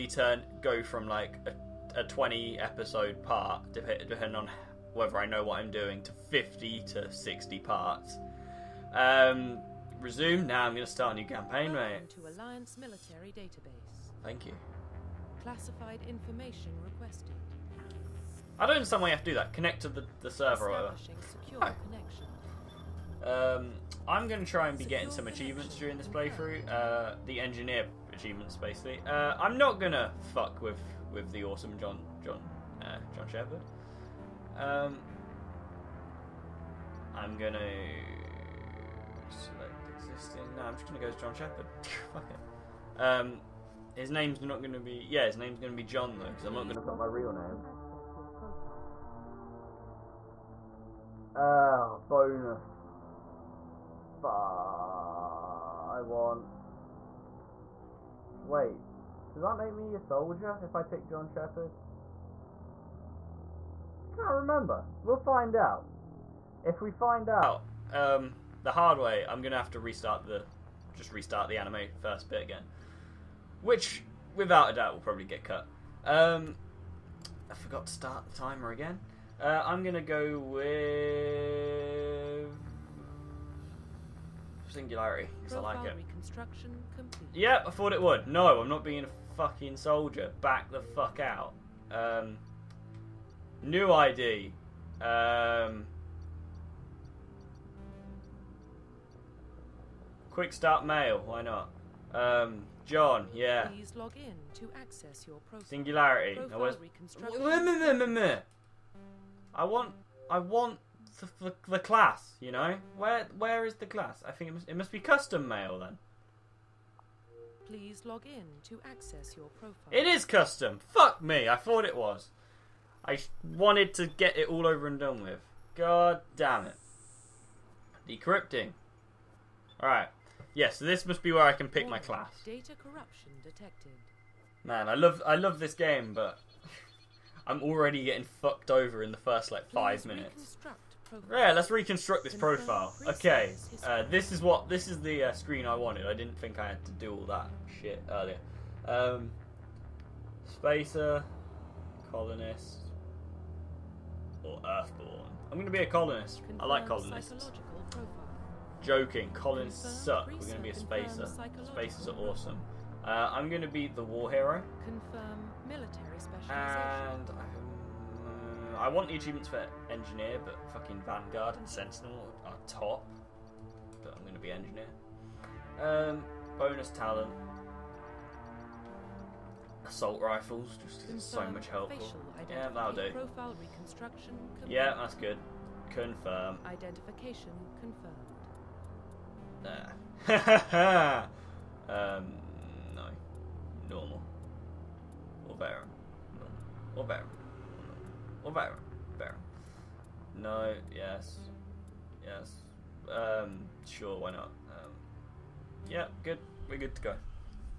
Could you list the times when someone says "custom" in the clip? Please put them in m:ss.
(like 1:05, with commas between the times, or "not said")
1:54, 2:00.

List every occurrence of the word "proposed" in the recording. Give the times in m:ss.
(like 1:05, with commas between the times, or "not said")
not said.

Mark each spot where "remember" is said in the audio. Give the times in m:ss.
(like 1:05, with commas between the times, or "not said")
1:04.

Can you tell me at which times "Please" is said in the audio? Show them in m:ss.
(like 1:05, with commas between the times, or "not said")
1:43, 1:57, 2:20.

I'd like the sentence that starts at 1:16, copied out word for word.
Um, I forgot to start the timer again.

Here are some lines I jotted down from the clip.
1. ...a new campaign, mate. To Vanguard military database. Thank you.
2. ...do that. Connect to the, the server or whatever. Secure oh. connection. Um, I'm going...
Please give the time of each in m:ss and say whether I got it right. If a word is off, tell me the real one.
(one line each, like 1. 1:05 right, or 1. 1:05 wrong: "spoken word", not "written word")
1. 0:11 wrong: "Alliance", not "Vanguard"
2. 0:19 right.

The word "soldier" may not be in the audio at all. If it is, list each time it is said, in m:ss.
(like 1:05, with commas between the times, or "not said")
0:59, 1:29.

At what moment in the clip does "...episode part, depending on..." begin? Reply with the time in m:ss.
0:02.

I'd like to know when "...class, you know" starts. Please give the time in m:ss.
1:51.